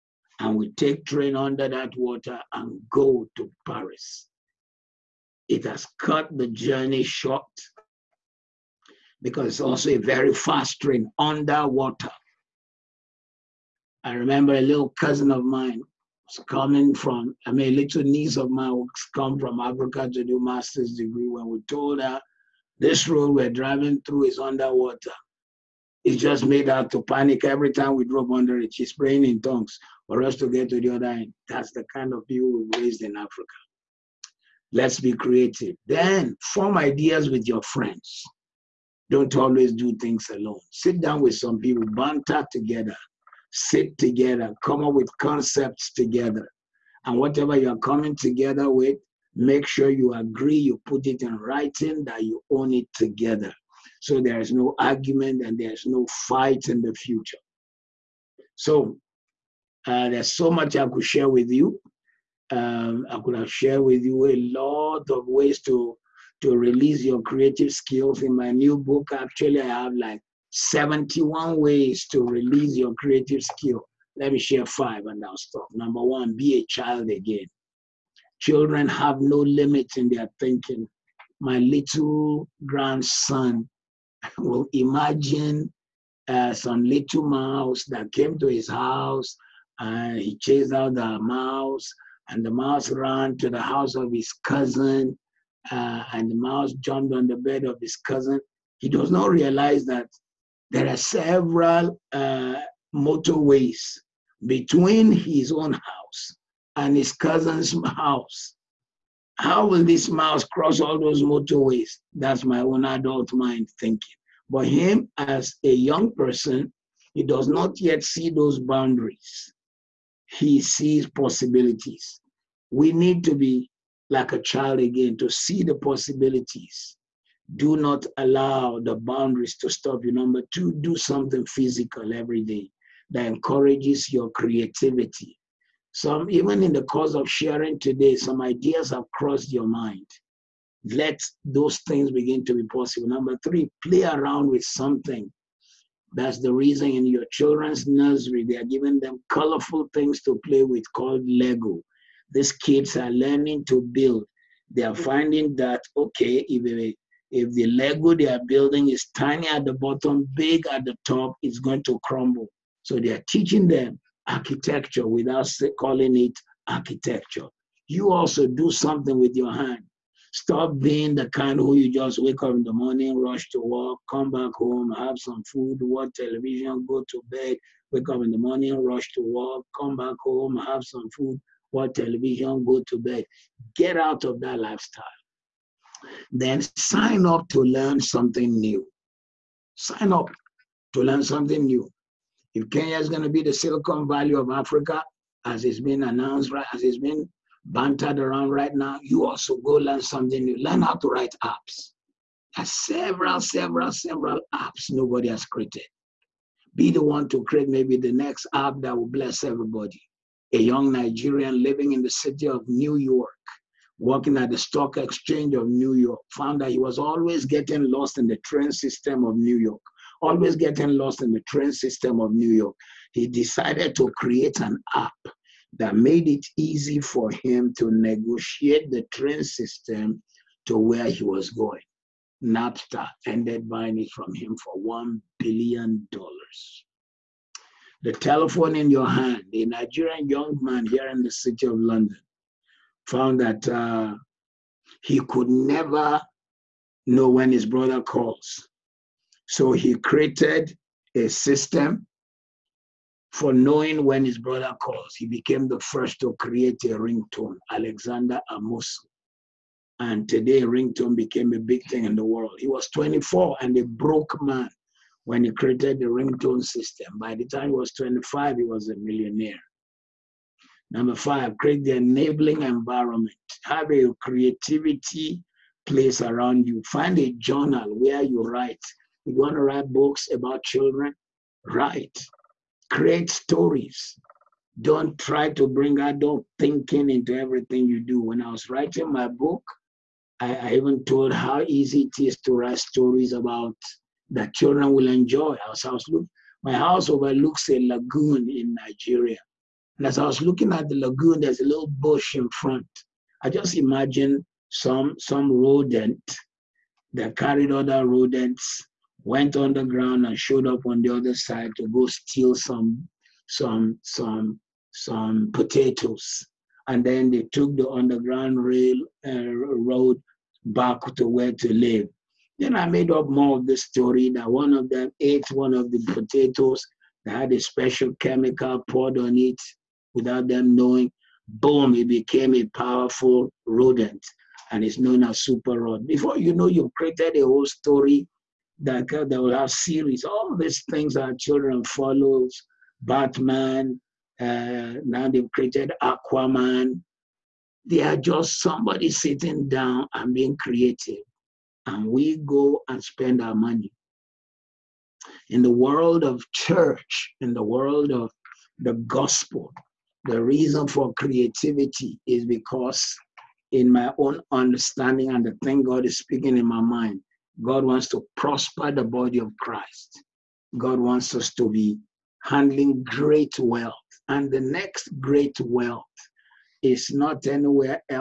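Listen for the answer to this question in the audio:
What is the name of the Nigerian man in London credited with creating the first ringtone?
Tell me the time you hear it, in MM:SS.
04:17.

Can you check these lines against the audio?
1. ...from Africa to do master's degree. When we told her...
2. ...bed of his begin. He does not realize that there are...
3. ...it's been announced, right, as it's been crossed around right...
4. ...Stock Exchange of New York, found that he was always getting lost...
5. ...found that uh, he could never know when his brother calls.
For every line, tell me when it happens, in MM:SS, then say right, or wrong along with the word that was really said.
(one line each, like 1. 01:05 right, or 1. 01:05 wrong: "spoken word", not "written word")
1. 00:19 right
2. 01:37 wrong: "cousin", not "begin"
3. 03:15 wrong: "bantered", not "crossed"
4. 03:34 right
5. 04:03 right.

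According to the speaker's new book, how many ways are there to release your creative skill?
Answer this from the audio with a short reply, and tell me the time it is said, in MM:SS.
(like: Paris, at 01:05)
71, at 01:10.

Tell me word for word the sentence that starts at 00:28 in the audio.
She's praying in tongues for us to get to the other end.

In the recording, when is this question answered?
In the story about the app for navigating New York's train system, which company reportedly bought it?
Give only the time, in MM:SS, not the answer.
03:52.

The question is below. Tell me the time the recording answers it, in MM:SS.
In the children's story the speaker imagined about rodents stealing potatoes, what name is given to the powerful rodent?
05:35.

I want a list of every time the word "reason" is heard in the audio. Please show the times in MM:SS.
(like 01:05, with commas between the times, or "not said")
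02:26, 06:00.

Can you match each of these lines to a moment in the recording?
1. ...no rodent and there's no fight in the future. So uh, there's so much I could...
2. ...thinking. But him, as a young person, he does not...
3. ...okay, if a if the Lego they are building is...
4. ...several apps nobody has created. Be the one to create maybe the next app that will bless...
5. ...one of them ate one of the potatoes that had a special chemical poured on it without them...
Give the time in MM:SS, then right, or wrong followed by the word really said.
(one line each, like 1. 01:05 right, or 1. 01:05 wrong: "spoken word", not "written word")
1. 00:54 wrong: "argument", not "rodent"
2. 01:53 right
3. 02:35 right
4. 03:23 right
5. 05:24 right.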